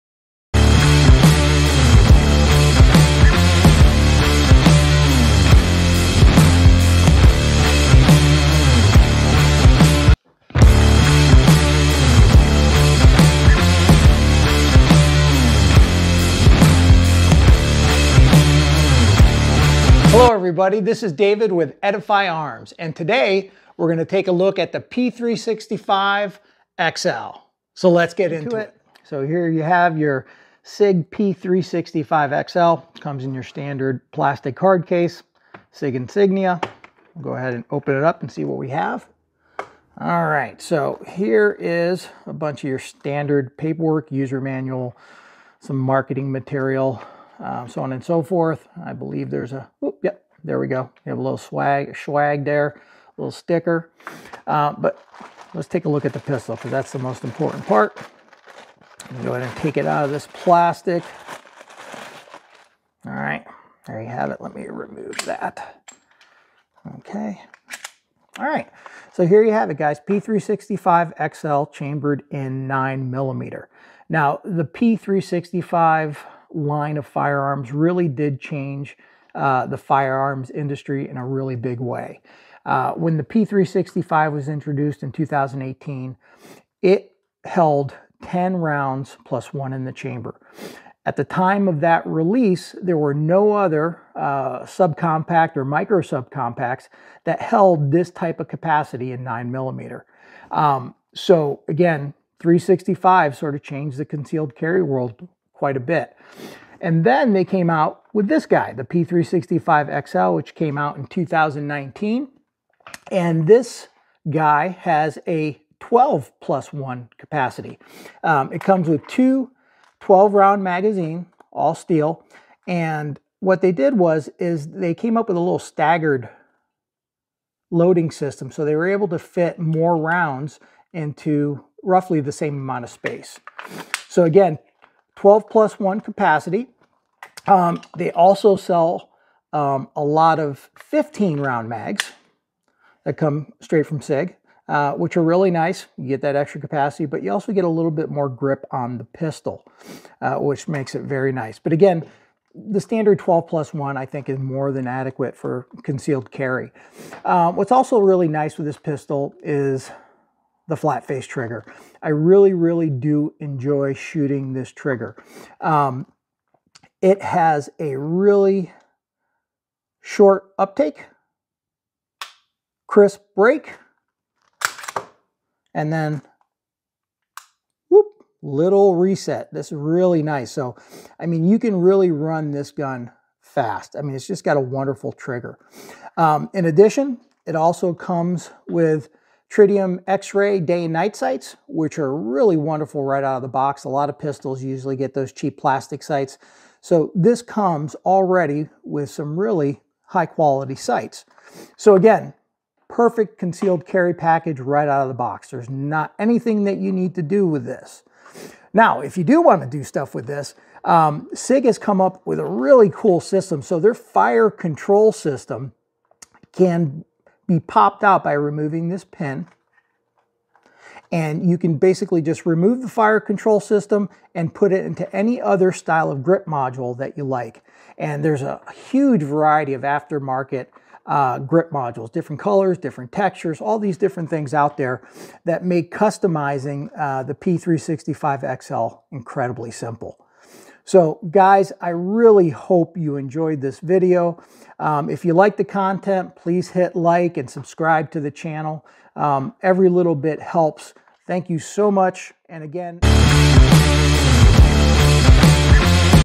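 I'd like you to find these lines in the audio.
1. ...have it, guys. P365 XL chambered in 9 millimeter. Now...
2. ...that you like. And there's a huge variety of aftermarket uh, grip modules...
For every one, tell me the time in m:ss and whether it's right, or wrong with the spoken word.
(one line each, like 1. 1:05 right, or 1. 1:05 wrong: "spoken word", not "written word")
1. 1:09 right
2. 3:46 right.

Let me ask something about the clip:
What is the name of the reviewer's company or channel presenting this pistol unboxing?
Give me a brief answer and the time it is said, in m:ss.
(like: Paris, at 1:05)
Edify Arms, at 0:21.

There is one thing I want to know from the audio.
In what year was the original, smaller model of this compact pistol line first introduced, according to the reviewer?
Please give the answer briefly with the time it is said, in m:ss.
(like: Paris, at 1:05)
2018, at 1:25.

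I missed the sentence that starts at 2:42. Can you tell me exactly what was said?
I really, really do enjoy shooting this trigger.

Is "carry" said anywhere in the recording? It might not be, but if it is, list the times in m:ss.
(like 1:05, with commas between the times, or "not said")
1:44, 2:36, 3:23.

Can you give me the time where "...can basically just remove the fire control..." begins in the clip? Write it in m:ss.
3:41.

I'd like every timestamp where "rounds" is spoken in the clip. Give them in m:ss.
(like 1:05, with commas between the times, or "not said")
1:28, 2:00, 2:09, 2:21.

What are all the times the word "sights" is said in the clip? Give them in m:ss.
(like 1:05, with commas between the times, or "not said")
3:11, 3:16, 3:20.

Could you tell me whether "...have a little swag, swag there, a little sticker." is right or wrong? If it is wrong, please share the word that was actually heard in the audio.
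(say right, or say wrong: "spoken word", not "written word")
right.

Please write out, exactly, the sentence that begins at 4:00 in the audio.
So guys, I really hope you enjoyed this video.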